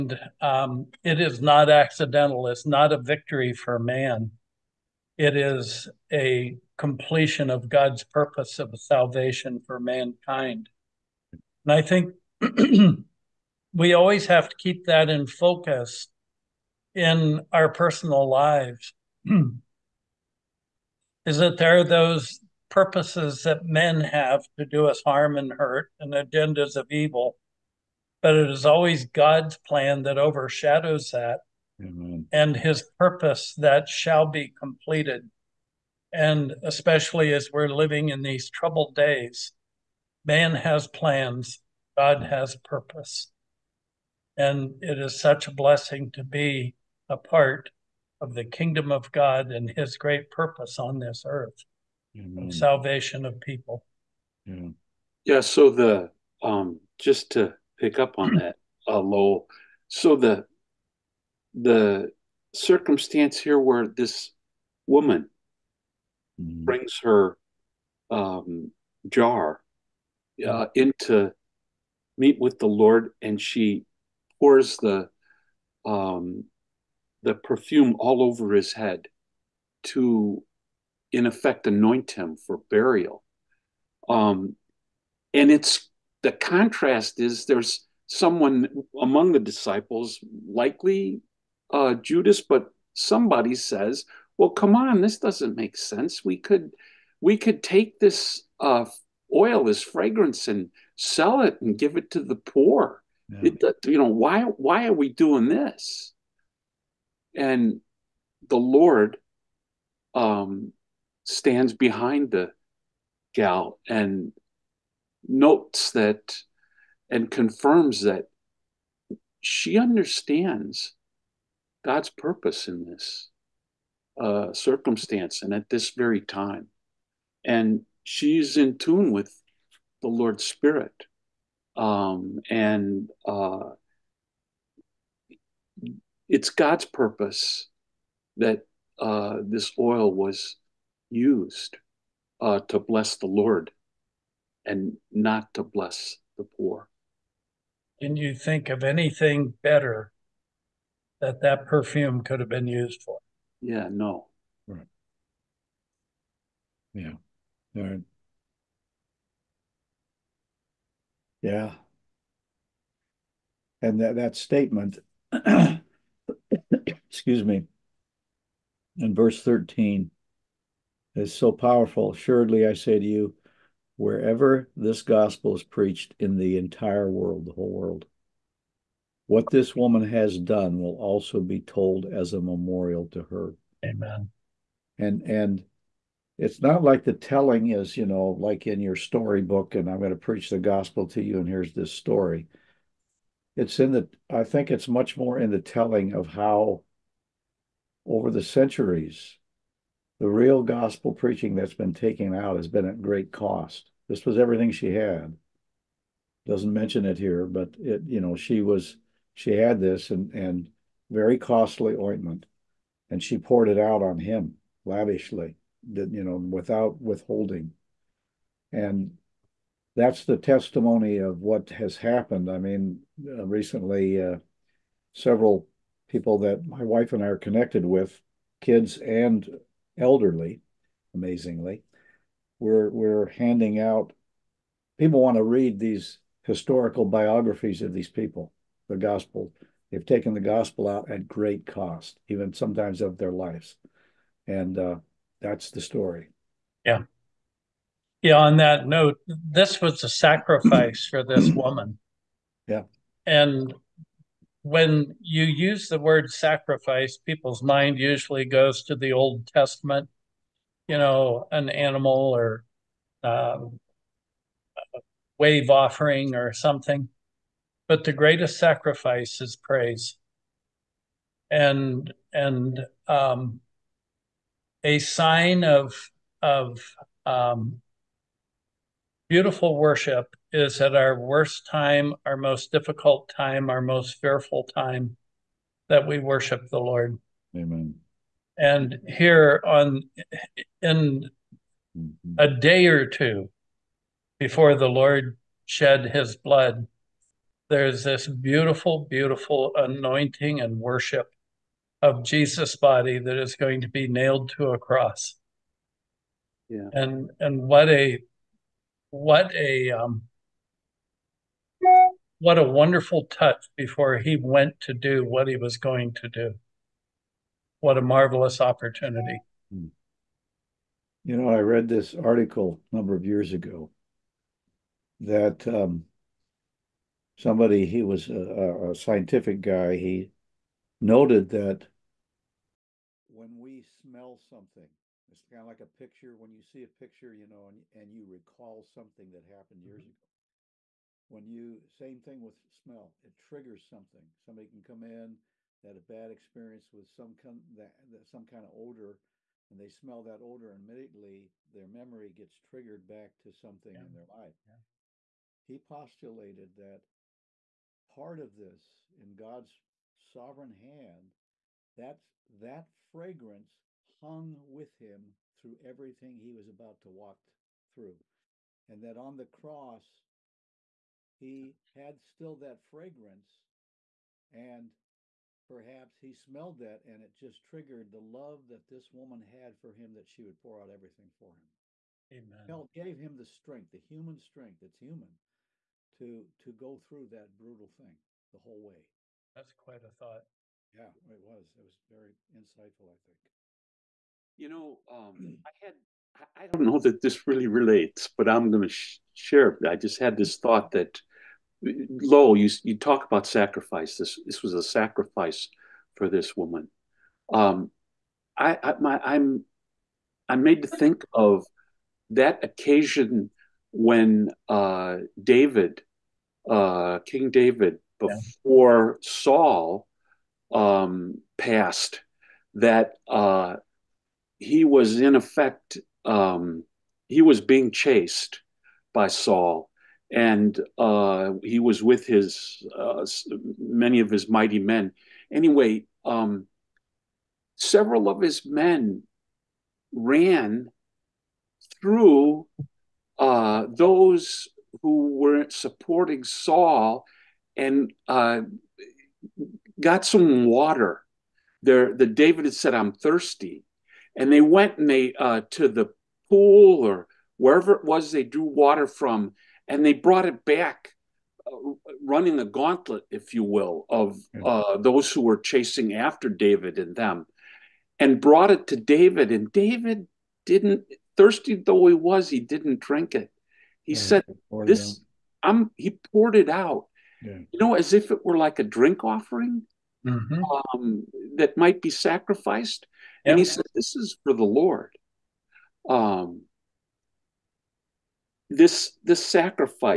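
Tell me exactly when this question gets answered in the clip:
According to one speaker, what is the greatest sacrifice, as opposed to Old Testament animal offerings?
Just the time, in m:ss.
4:29.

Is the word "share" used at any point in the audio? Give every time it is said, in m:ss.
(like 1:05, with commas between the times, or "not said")
6:39.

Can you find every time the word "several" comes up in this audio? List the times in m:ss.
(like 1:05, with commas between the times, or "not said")
3:45, 7:17.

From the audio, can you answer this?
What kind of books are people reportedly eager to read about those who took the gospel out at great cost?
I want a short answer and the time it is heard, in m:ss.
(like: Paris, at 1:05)
historical biographies, at 3:56.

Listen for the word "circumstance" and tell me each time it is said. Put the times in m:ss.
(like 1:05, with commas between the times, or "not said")
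1:02, 2:04.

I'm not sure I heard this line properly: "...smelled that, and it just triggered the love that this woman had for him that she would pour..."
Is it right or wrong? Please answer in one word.
right.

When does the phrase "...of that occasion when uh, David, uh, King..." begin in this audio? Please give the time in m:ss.
6:51.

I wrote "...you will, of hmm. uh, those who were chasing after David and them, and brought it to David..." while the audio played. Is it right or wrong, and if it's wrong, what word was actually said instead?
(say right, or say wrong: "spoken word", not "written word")
right.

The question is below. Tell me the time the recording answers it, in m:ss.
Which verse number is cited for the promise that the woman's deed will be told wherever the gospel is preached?
2:49.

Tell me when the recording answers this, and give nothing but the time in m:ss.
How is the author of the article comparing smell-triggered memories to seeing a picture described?
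5:28.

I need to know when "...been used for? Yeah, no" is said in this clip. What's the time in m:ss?
2:32.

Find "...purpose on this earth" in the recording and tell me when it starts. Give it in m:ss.
0:50.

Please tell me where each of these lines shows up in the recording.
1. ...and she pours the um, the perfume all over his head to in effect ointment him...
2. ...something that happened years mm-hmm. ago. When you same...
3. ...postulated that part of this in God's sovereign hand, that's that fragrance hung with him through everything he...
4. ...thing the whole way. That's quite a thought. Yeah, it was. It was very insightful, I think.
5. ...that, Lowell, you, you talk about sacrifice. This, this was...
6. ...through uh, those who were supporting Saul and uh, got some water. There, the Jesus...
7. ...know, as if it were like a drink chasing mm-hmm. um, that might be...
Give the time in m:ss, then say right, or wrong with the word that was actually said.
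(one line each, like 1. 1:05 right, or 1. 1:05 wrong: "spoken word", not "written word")
1. 1:13 wrong: "anoint", not "ointment"
2. 5:38 right
3. 5:55 right
4. 6:27 right
5. 6:40 right
6. 7:22 wrong: "David", not "Jesus"
7. 7:57 wrong: "offering", not "chasing".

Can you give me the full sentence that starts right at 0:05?
It is a completion of God's purpose of salvation for mankind.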